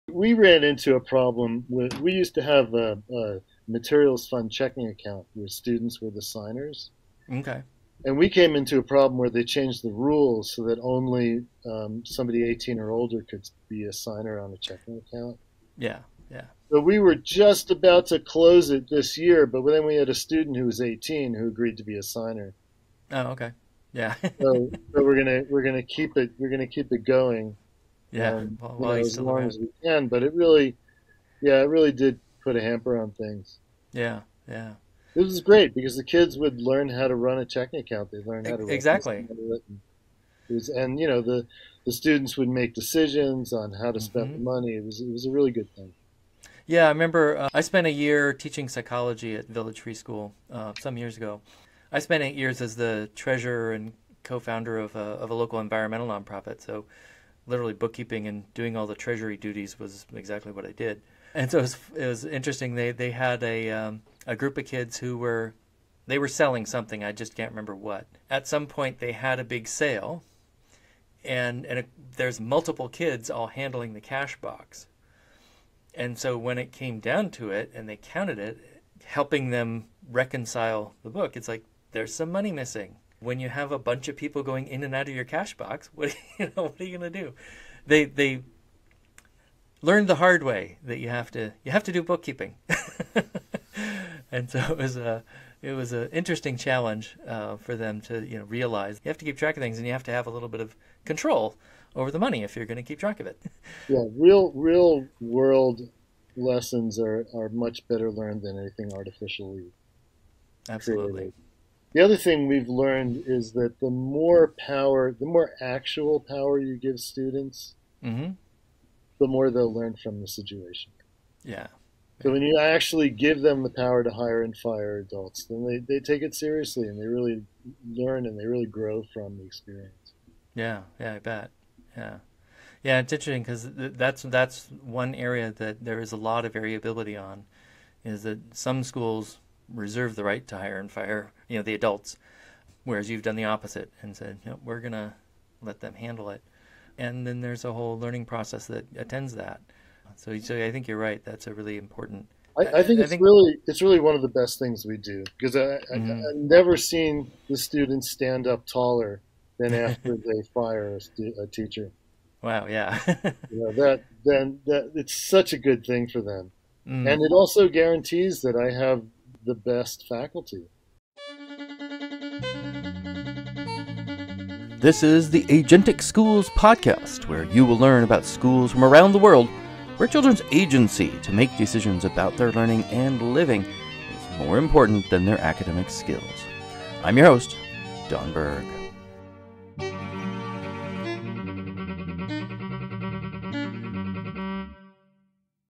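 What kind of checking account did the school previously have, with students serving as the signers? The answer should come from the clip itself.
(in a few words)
Materials fund.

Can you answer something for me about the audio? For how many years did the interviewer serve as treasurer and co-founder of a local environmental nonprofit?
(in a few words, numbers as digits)
8.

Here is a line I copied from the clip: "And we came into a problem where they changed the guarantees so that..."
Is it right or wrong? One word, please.
wrong.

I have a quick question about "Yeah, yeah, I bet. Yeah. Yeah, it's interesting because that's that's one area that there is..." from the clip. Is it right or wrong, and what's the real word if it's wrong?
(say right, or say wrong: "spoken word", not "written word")
right.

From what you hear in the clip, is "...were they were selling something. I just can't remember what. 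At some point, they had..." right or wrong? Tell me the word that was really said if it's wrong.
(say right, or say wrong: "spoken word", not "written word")
right.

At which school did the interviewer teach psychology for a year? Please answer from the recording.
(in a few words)
Village Free School.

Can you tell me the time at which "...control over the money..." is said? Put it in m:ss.
1:41.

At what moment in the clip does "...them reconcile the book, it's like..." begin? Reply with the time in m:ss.
1:19.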